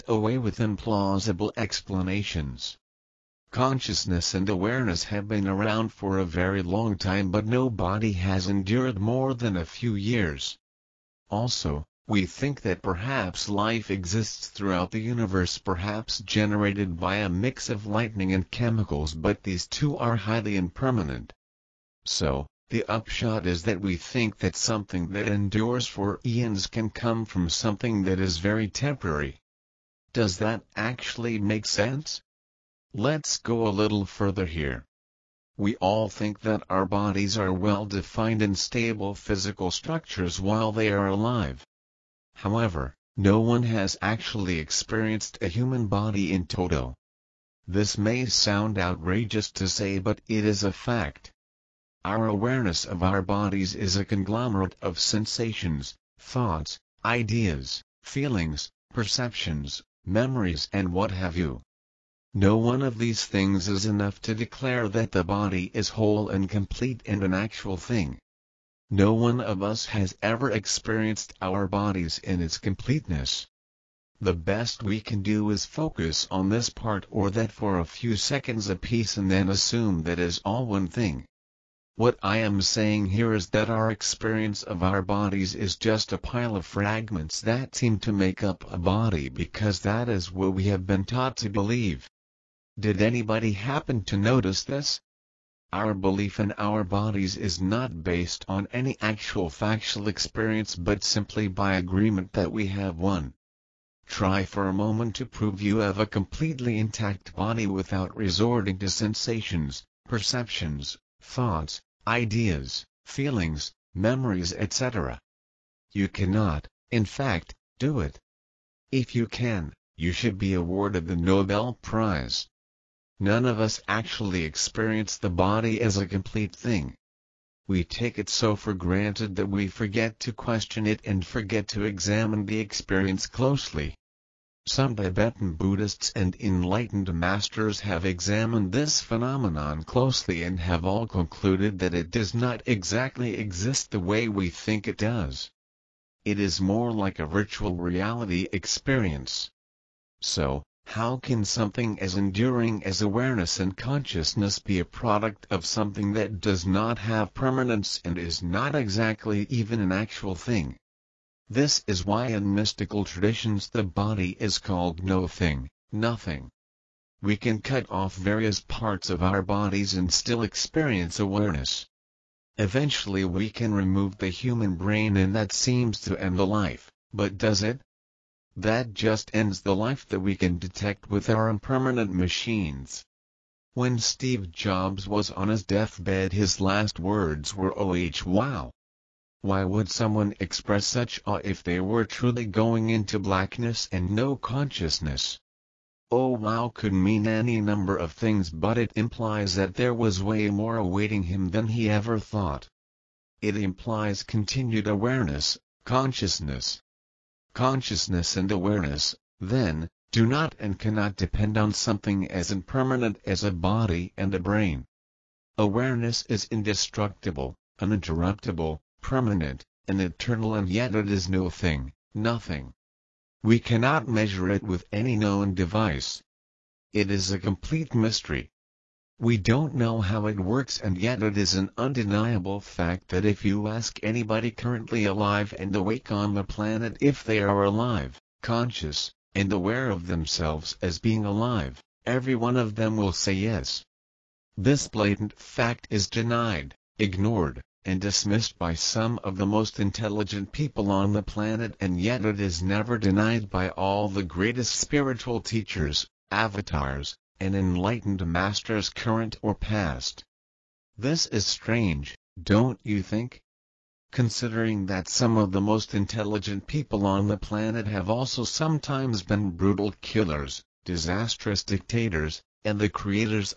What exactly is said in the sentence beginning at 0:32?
Let's go a little further here.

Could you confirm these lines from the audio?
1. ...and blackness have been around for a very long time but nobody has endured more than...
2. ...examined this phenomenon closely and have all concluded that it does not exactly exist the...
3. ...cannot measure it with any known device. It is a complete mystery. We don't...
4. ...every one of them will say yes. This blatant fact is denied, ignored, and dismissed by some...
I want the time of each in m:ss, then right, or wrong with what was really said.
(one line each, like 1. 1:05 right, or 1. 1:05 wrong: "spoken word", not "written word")
1. 0:04 wrong: "awareness", not "blackness"
2. 2:18 right
3. 3:43 right
4. 4:02 right.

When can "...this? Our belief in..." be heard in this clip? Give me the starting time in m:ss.
1:34.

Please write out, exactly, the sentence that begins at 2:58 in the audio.
That just ends the life that we can detect with our impermanent machines.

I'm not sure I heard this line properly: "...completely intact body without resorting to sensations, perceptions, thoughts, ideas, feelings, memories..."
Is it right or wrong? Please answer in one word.
right.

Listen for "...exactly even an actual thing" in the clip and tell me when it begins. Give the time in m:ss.
2:38.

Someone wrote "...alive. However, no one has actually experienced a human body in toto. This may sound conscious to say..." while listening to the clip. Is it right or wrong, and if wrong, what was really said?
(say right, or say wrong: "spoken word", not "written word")
wrong: "outrageous", not "conscious".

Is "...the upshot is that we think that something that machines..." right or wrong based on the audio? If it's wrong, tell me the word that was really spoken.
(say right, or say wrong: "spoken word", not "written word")
wrong: "endures", not "machines".